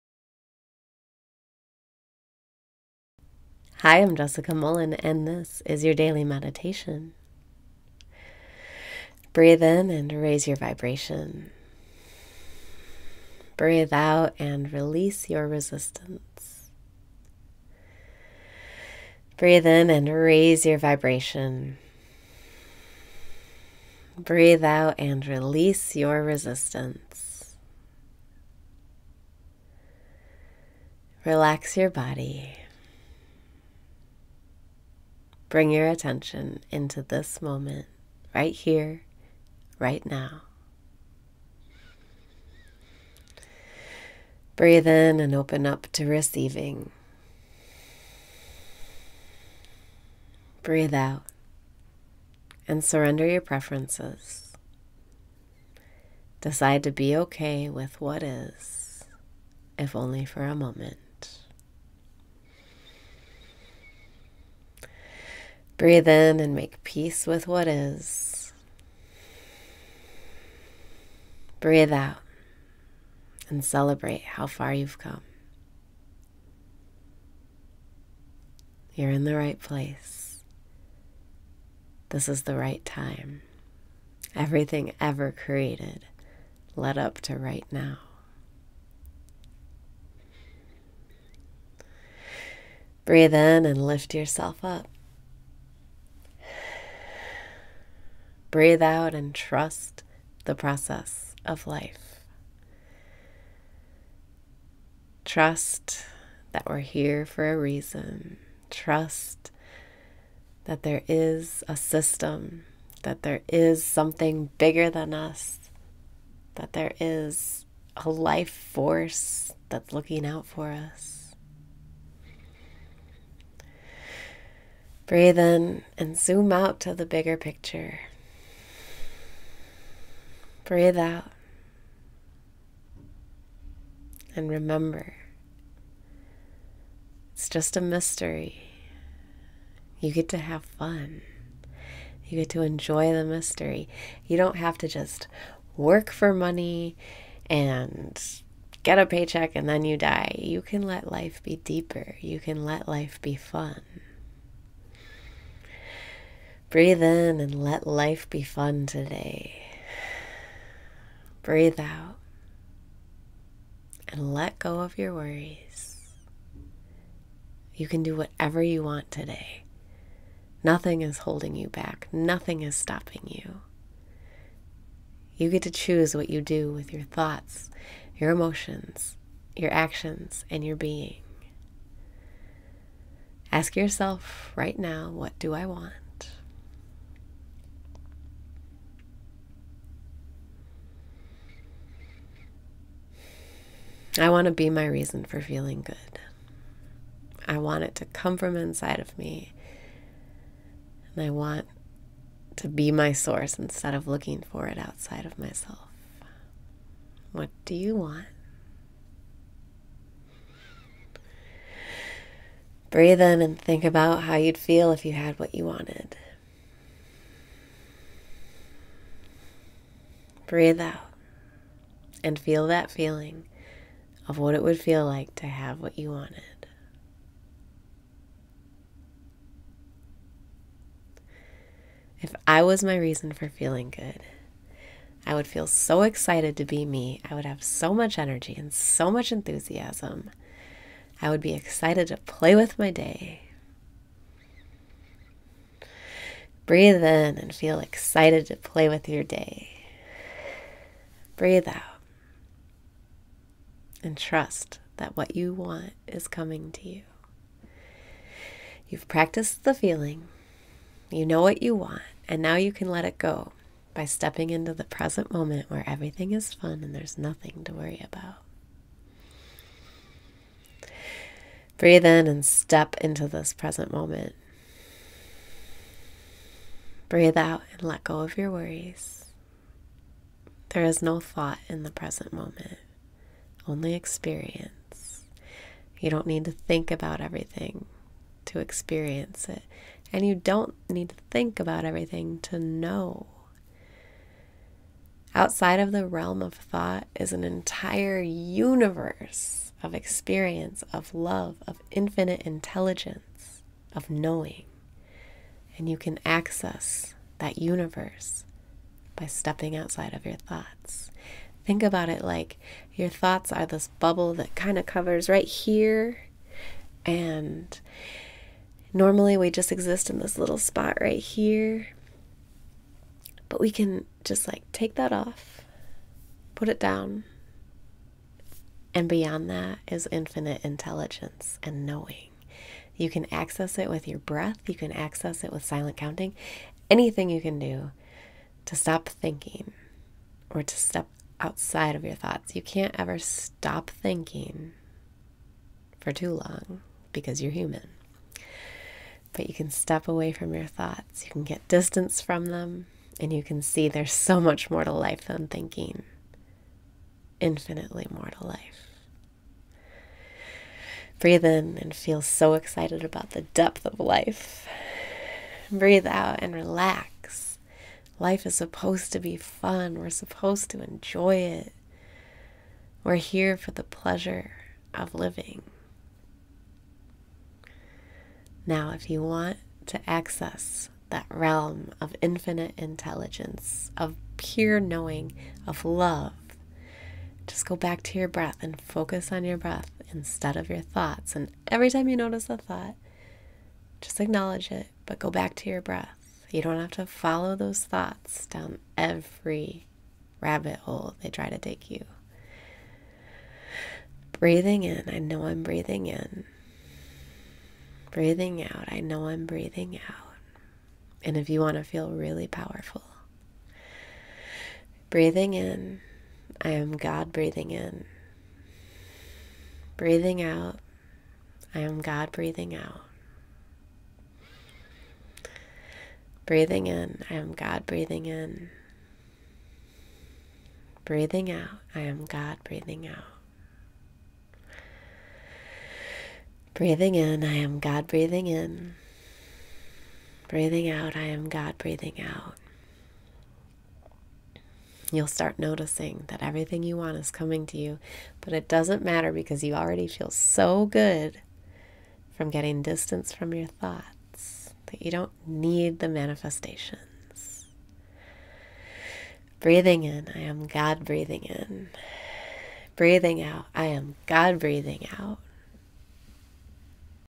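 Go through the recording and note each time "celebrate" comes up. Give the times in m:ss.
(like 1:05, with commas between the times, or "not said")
1:13.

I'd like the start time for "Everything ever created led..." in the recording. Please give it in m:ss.
1:24.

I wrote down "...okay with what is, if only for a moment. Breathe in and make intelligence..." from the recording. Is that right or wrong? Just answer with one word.
wrong.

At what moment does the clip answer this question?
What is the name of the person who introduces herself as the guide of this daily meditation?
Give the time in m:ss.
0:04.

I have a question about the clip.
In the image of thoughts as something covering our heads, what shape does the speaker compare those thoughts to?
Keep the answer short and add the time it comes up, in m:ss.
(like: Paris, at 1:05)
bubble, at 5:13.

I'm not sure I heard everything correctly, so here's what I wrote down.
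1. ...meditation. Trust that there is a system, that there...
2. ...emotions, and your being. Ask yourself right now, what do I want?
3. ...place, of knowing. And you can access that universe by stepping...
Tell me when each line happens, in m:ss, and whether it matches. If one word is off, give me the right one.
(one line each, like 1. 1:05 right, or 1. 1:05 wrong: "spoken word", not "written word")
1. 1:47 wrong: "reason", not "meditation"
2. 2:59 wrong: "actions", not "emotions"
3. 5:02 wrong: "intelligence", not "place".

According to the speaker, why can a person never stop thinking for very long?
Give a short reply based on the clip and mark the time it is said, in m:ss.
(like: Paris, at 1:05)
because you're human, at 5:47.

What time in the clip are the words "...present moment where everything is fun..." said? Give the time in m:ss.
4:24.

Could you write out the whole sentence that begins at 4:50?
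And you don't need to think about everything to know.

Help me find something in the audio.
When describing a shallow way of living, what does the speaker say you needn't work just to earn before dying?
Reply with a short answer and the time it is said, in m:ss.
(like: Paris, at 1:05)
a paycheck, at 2:28.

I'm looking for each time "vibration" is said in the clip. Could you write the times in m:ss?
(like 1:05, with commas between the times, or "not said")
0:10, 0:20.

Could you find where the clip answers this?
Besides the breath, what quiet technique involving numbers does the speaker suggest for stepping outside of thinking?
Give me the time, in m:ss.
5:35.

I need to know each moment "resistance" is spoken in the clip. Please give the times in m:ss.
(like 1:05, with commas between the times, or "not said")
0:15, 0:26.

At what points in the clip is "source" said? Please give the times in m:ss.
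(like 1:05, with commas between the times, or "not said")
3:23.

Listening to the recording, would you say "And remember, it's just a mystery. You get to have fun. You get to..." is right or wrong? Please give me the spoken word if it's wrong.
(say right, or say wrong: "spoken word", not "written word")
right.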